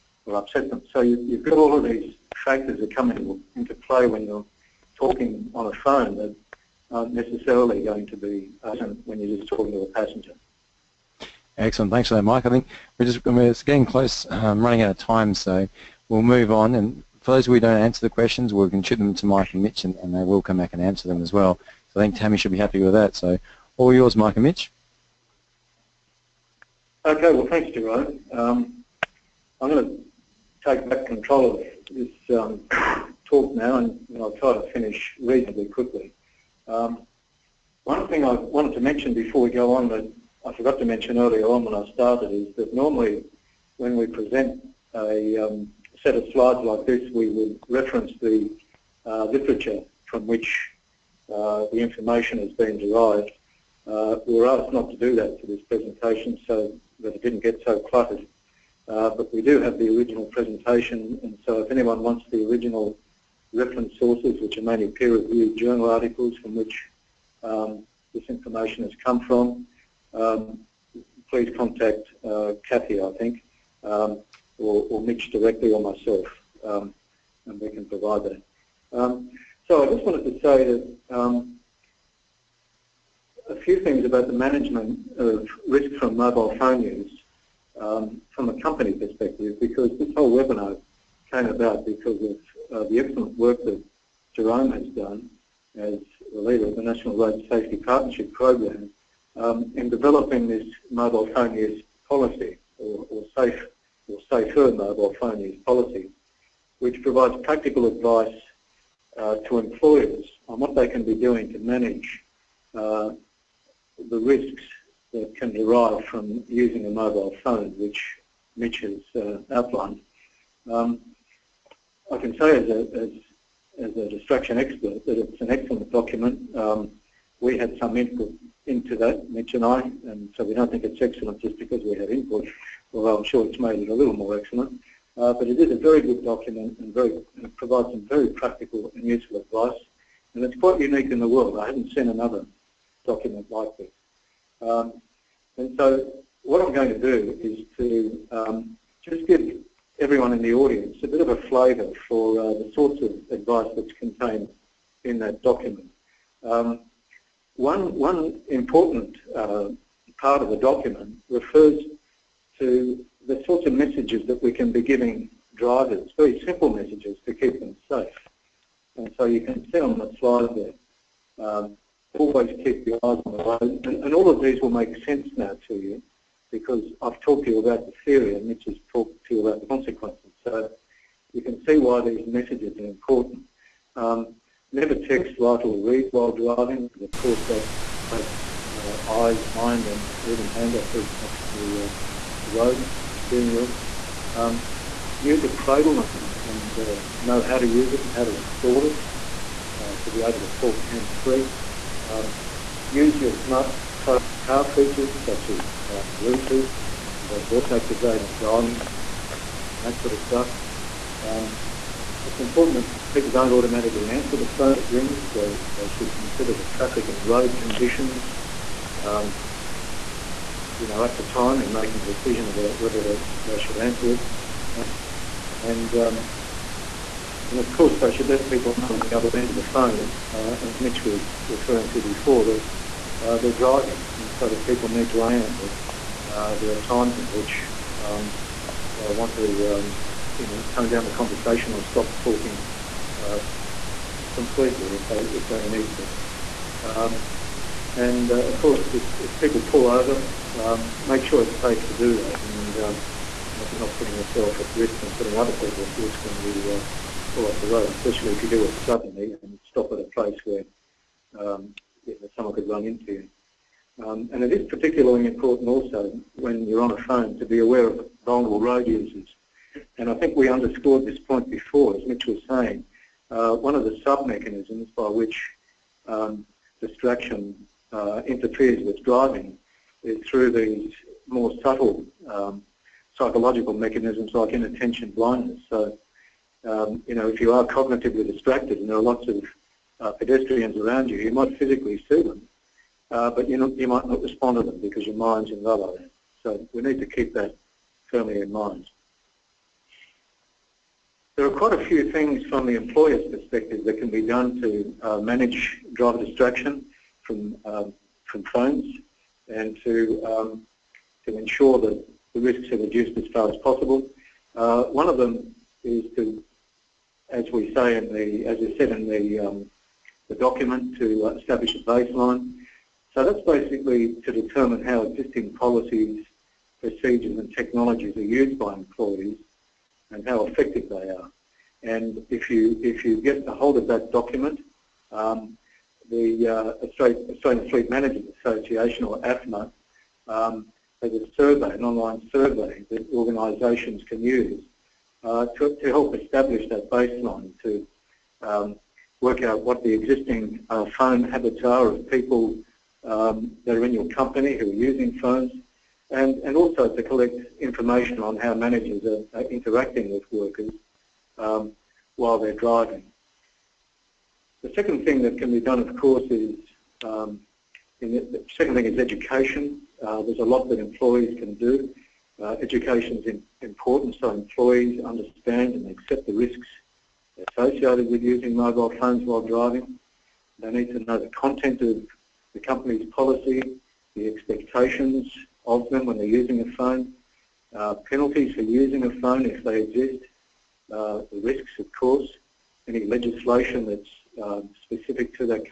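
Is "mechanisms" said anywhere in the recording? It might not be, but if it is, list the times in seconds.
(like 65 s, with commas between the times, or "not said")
274 s, 283 s.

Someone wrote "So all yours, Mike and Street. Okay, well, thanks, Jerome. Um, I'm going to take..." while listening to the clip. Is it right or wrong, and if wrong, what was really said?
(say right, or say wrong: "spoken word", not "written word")
wrong: "Mitch", not "Street".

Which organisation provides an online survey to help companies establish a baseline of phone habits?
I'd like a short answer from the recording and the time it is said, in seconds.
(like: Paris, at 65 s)
AFMA, at 339 s.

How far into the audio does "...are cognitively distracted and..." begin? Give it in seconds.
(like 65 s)
287 s.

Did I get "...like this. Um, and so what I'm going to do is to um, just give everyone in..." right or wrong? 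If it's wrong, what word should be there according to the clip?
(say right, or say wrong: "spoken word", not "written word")
right.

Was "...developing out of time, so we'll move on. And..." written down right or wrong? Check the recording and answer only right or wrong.
wrong.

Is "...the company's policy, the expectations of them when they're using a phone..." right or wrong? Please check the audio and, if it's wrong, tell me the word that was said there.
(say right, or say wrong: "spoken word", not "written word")
right.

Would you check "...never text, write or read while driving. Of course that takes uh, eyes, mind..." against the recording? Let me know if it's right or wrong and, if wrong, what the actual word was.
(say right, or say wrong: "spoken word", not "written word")
right.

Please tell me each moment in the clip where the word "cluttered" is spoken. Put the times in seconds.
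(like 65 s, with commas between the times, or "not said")
57 s.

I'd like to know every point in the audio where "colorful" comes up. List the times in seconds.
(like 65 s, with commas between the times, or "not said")
not said.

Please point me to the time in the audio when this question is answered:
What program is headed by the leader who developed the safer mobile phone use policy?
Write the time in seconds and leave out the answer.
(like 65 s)
96 s.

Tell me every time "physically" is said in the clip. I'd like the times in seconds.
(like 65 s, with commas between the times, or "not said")
291 s.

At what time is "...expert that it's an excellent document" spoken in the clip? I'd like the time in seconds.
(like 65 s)
124 s.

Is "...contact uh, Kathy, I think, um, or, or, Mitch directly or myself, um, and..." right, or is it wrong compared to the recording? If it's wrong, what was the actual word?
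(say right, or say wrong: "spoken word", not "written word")
right.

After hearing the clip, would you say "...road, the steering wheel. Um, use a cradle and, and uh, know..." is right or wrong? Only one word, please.
right.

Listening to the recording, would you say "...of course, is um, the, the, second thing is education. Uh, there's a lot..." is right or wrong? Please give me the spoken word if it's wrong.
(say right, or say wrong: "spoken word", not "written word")
right.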